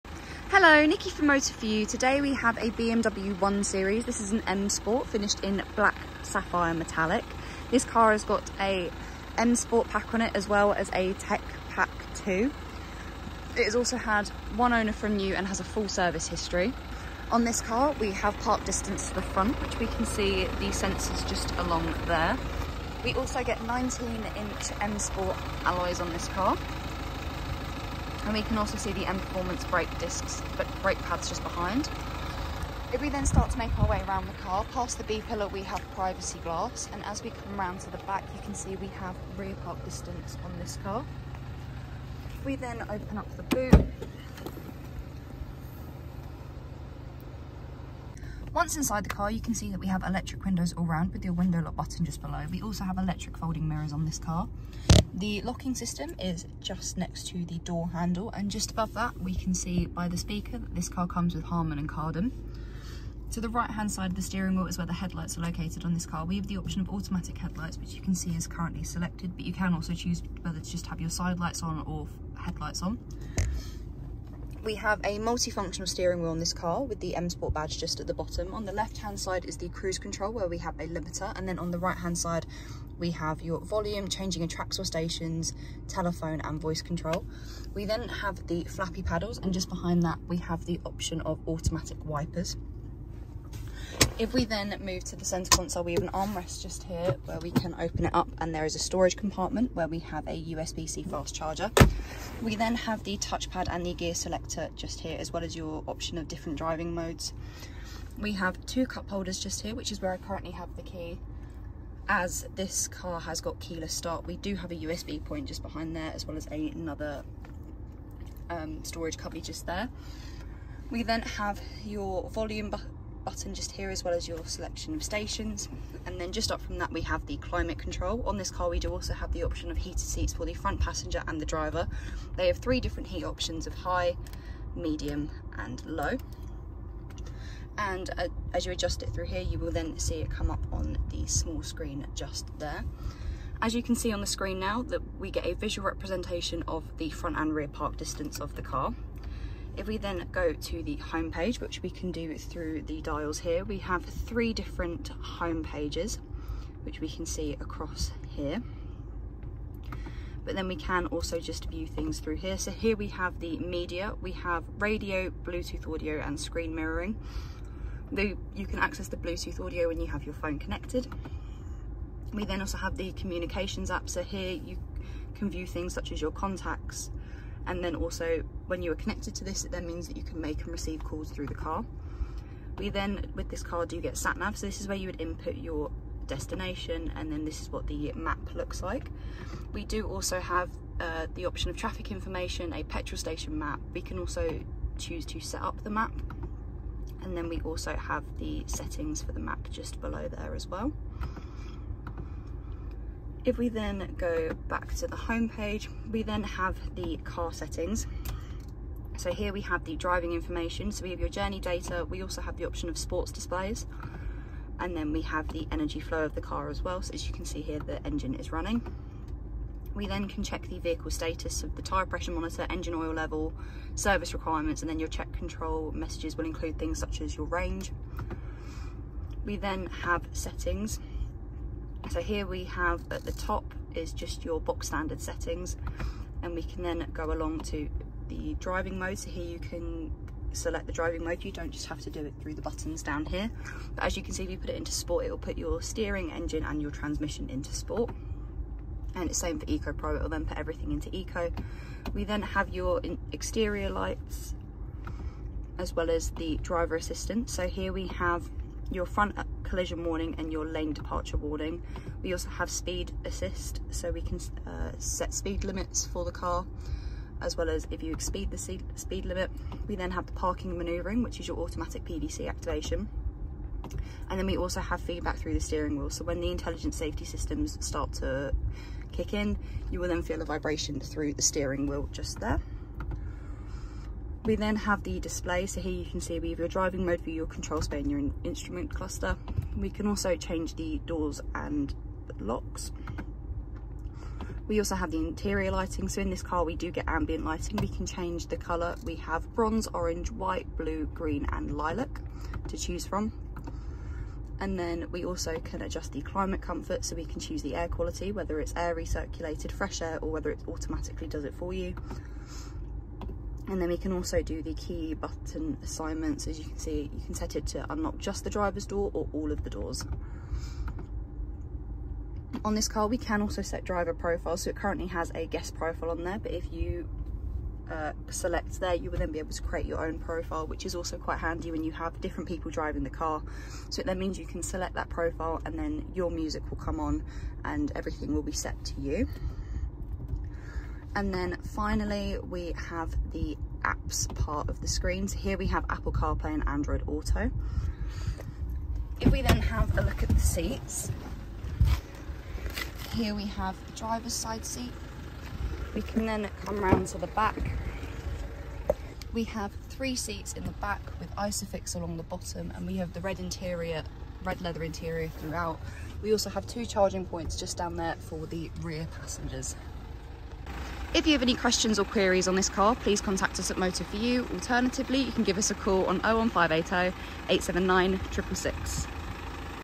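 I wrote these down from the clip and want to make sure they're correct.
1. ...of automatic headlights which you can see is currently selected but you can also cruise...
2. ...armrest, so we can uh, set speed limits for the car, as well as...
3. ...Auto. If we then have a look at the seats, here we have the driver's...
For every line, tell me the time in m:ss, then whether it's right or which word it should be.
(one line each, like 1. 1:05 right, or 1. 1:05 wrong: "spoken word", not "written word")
1. 1:06 wrong: "choose", not "cruise"
2. 4:23 wrong: "assist", not "armrest"
3. 5:47 right.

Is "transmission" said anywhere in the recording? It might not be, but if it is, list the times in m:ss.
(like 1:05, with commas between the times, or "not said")
4:06.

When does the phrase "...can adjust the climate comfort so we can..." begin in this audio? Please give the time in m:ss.
5:05.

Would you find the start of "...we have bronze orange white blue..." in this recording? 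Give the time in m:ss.
4:59.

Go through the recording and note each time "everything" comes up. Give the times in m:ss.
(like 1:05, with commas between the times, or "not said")
4:10, 5:37.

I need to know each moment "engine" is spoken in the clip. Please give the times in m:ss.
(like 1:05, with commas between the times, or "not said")
3:38, 3:42, 4:06.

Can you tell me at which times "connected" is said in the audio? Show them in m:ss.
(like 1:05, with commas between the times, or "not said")
2:50, 2:58.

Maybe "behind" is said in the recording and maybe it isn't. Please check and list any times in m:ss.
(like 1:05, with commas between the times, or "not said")
0:31, 1:29, 1:55.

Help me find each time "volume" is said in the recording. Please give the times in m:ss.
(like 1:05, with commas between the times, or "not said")
1:23, 2:02.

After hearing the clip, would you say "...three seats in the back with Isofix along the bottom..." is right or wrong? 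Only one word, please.
right.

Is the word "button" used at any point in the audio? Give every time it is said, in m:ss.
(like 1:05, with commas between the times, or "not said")
0:51, 2:03, 4:02, 5:15.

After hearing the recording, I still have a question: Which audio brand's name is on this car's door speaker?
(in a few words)
Harman and Kardon.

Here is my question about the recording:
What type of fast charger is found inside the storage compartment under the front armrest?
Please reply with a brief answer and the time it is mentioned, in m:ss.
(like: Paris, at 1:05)
USB-C, at 1:40.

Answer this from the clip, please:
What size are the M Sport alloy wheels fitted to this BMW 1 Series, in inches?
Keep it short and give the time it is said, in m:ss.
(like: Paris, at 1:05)
19, at 0:23.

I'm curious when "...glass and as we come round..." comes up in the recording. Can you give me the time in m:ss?
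0:36.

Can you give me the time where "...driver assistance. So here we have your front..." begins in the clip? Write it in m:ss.
4:16.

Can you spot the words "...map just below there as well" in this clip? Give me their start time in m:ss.
3:19.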